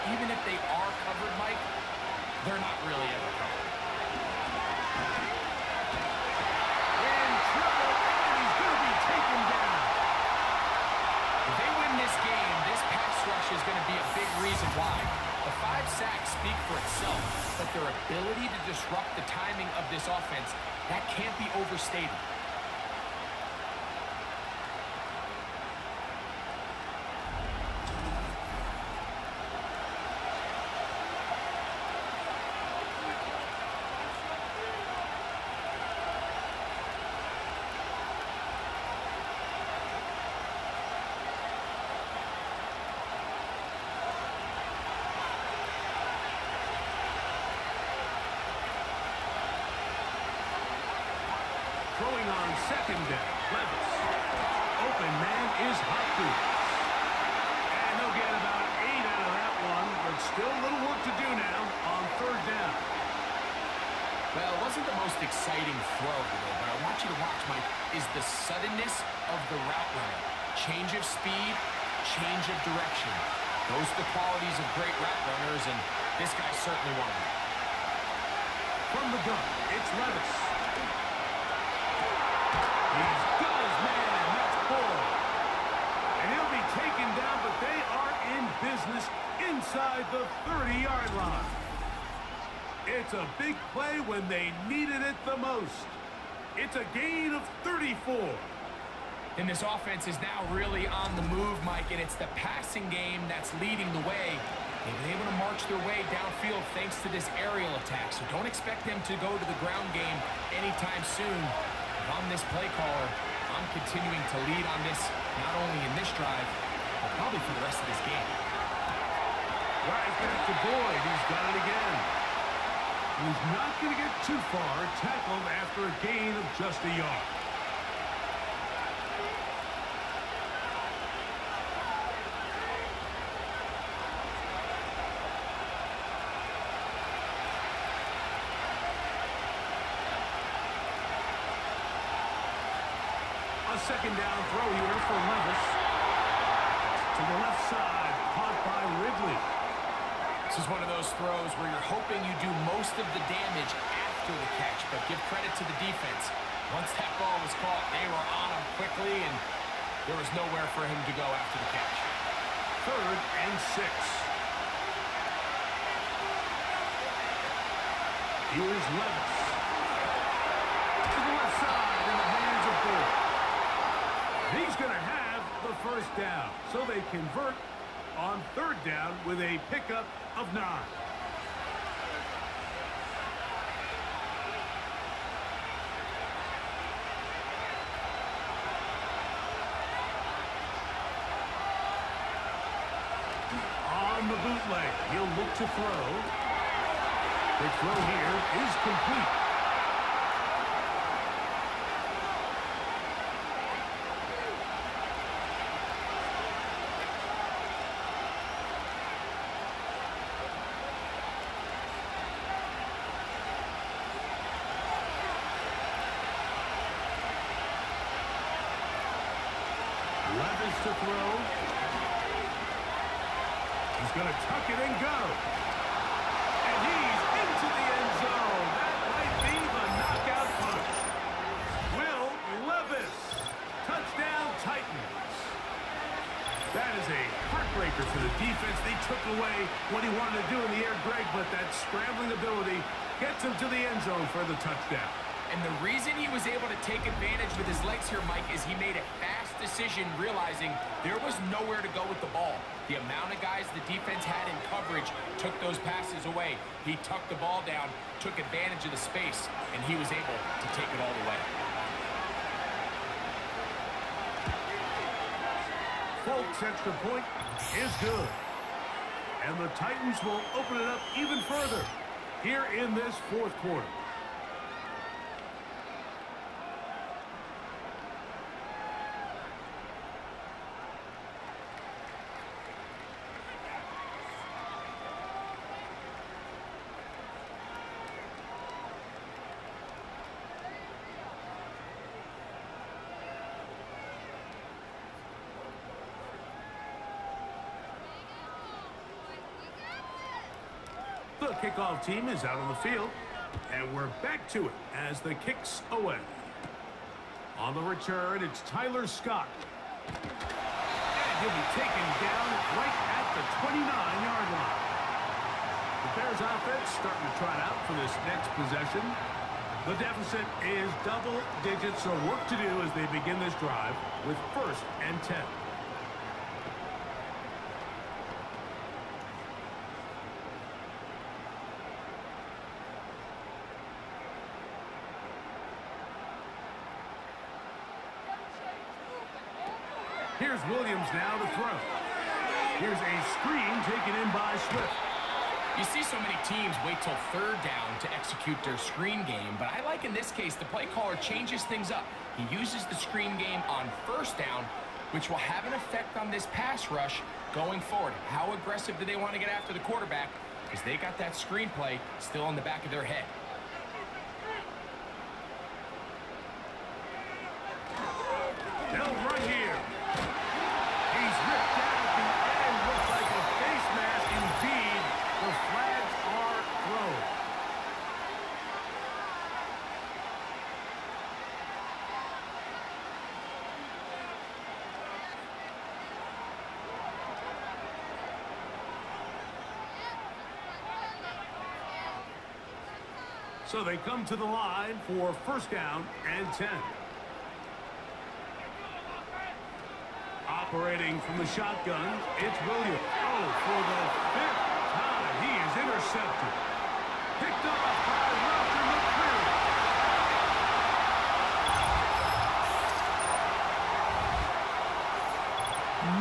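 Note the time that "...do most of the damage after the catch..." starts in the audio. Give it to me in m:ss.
2:32.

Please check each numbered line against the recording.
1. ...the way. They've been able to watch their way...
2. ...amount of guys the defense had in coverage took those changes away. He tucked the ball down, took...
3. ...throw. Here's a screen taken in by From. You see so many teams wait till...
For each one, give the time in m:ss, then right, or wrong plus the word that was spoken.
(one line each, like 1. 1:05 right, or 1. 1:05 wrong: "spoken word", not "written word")
1. 1:43 wrong: "march", not "watch"
2. 4:12 wrong: "passes", not "changes"
3. 5:41 wrong: "Swift", not "From".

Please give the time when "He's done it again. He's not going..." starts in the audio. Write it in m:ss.
2:01.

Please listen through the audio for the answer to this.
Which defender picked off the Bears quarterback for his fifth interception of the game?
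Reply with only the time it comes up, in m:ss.
6:48.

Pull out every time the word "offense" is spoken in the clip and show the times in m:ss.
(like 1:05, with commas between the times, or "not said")
0:20, 1:39, 5:16.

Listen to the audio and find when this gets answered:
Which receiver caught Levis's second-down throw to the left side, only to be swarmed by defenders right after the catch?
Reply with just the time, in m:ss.
2:29.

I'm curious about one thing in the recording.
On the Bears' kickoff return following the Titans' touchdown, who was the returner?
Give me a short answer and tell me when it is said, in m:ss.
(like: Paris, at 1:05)
Tyler Scott, at 5:08.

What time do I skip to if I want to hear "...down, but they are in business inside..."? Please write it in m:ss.
1:27.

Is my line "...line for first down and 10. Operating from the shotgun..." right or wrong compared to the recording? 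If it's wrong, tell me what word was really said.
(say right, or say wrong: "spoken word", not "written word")
right.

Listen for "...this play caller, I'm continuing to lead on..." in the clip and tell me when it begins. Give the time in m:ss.
1:52.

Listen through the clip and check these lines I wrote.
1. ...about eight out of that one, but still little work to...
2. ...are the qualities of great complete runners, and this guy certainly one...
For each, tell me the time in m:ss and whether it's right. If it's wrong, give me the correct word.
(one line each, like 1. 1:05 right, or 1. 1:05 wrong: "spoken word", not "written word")
1. 0:58 right
2. 1:13 wrong: "route", not "complete".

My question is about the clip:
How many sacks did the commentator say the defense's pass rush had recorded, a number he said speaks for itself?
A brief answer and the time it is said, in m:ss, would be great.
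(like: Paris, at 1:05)
5, at 0:15.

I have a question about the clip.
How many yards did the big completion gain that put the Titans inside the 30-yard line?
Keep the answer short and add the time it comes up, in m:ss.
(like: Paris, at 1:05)
34, at 1:36.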